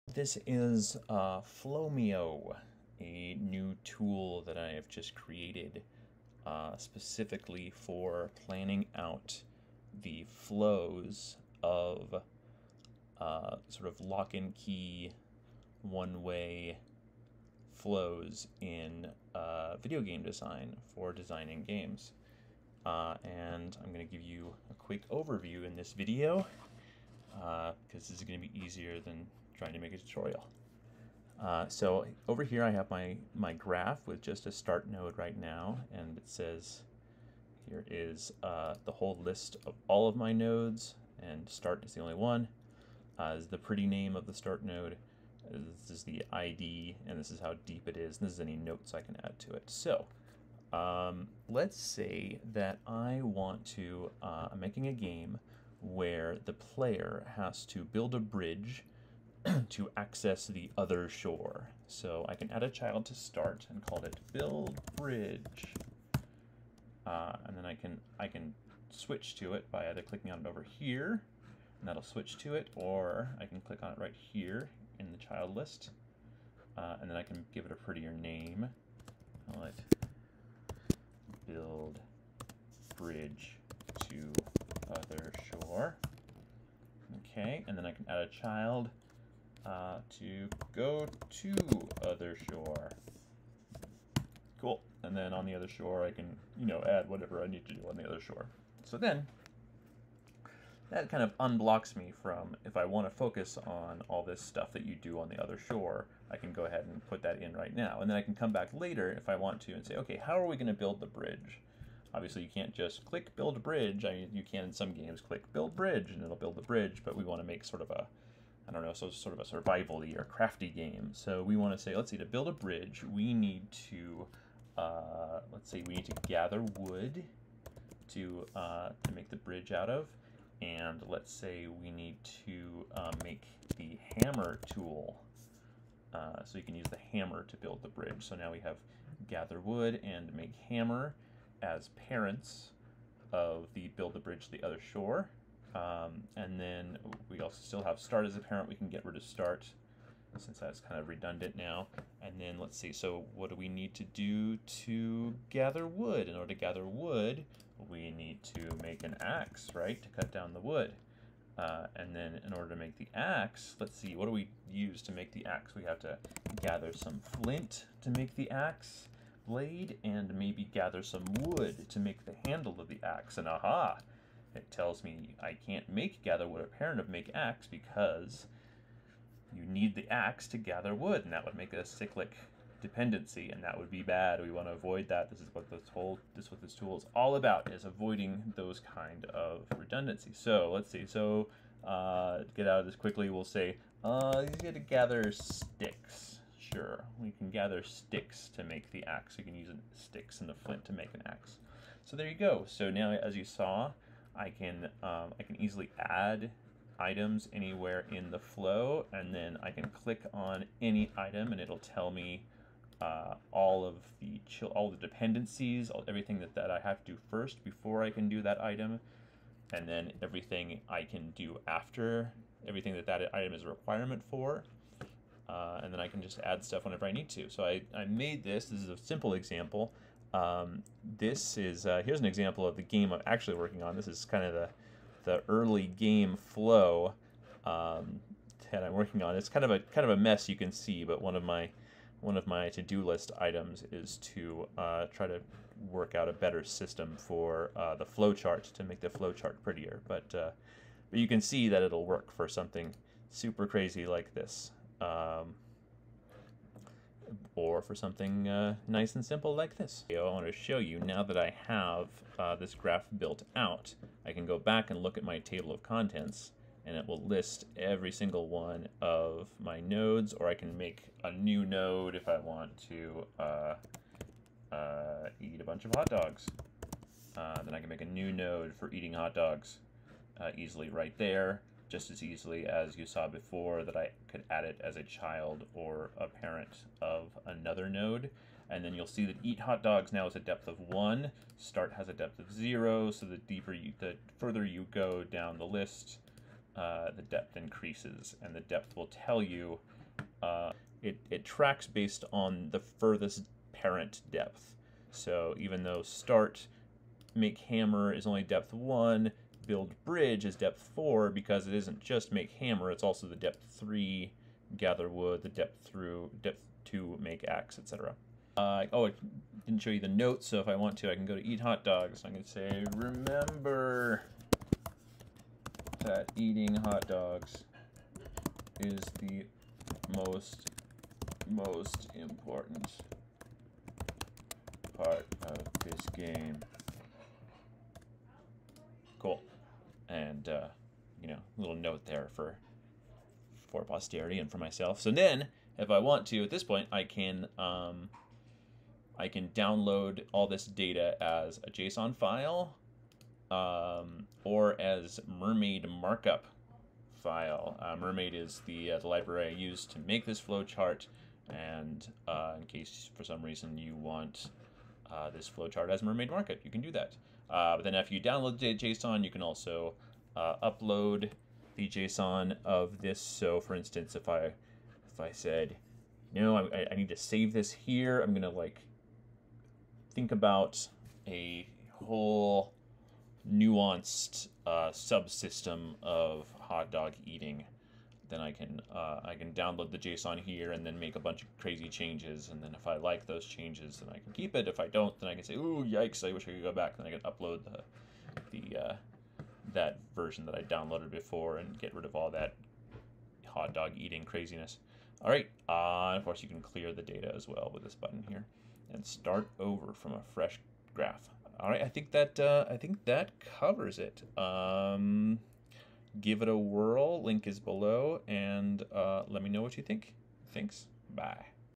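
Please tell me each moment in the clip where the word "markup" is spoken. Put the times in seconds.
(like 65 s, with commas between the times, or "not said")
355 s, 366 s.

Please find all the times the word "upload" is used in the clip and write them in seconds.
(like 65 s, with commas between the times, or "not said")
370 s, 397 s.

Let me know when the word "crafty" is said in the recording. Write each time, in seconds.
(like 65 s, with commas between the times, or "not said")
120 s.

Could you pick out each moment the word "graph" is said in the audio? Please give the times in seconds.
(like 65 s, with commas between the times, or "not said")
33 s, 262 s, 410 s.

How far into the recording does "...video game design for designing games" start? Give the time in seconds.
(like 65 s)
19 s.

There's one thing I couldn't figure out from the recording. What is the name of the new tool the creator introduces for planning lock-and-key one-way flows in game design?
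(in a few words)
Flowmeo.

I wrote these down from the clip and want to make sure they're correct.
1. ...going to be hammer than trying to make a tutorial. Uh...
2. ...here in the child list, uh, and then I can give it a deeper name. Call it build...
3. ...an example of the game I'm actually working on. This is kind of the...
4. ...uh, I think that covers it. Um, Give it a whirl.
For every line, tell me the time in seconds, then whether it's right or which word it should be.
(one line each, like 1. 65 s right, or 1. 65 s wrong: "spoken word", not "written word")
1. 28 s wrong: "easier", not "hammer"
2. 74 s wrong: "prettier", not "deeper"
3. 232 s right
4. 412 s right.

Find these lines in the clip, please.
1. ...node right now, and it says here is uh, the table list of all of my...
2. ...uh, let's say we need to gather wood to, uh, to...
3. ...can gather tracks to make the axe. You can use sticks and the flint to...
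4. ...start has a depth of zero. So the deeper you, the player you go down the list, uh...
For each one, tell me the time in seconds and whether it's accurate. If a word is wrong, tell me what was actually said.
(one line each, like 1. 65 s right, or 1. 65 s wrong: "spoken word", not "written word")
1. 34 s wrong: "whole", not "table"
2. 124 s right
3. 197 s wrong: "sticks", not "tracks"
4. 291 s wrong: "further", not "player".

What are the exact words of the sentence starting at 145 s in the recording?
Um, and then we also still have start as a parent.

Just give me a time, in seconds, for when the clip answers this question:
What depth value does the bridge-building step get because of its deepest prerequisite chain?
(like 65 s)
310 s.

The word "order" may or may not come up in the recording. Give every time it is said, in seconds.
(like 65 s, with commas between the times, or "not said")
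156 s, 162 s.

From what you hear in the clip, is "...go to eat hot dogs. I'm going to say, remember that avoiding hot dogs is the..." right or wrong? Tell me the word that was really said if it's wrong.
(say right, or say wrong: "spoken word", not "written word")
wrong: "eating", not "avoiding".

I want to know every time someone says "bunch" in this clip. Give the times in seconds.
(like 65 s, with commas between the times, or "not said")
275 s, 391 s.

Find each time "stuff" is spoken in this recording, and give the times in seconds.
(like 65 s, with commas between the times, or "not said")
104 s, 226 s.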